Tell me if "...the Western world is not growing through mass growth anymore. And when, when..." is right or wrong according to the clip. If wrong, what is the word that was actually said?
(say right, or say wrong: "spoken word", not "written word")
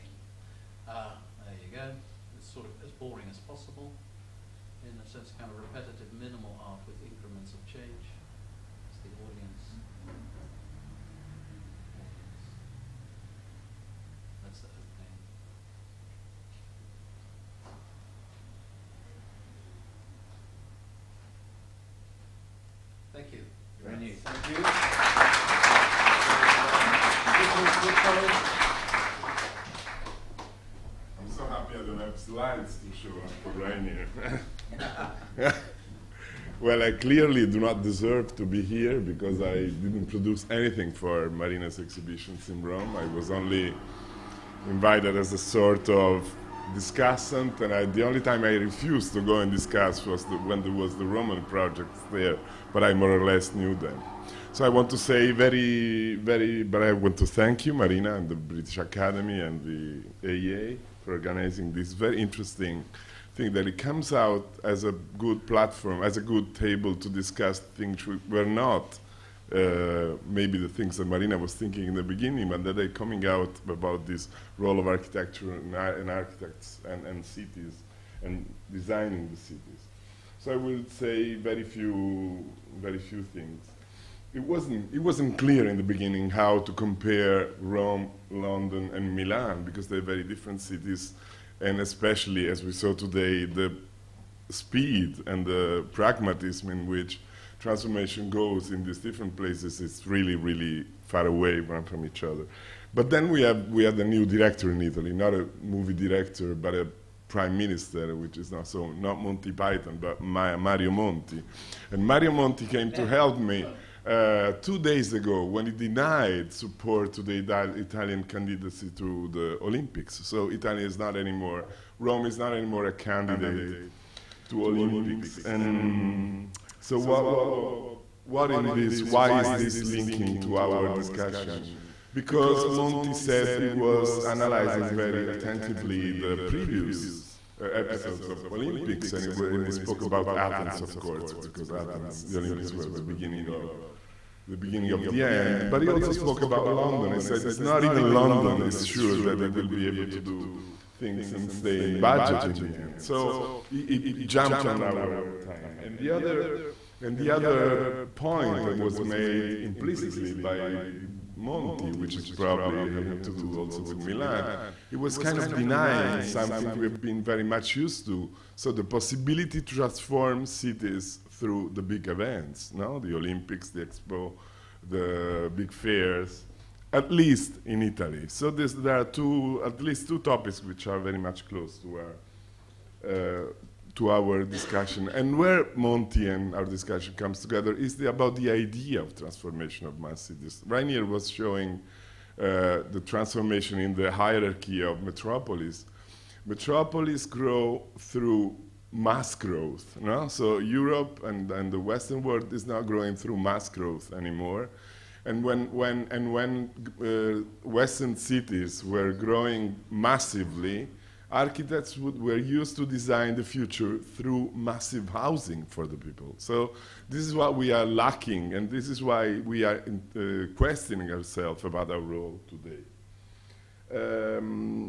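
right.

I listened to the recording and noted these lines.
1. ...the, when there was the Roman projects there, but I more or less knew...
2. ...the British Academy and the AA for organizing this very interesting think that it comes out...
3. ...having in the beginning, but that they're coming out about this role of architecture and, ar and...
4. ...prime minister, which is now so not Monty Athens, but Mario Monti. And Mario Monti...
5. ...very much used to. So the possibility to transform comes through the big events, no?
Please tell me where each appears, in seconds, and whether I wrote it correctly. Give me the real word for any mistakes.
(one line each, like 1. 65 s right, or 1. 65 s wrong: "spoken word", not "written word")
1. 50 s right
2. 58 s right
3. 71 s wrong: "thinking", not "having"
4. 107 s wrong: "Python", not "Athens"
5. 167 s wrong: "cities", not "comes".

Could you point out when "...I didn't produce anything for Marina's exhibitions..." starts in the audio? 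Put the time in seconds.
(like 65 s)
39 s.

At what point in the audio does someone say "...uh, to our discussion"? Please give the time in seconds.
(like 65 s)
183 s.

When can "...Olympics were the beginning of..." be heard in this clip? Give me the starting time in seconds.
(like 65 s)
142 s.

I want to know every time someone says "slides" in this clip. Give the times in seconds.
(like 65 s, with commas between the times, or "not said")
32 s.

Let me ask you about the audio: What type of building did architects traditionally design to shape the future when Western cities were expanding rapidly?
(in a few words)
massive housing.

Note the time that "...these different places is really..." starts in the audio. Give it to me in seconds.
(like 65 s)
98 s.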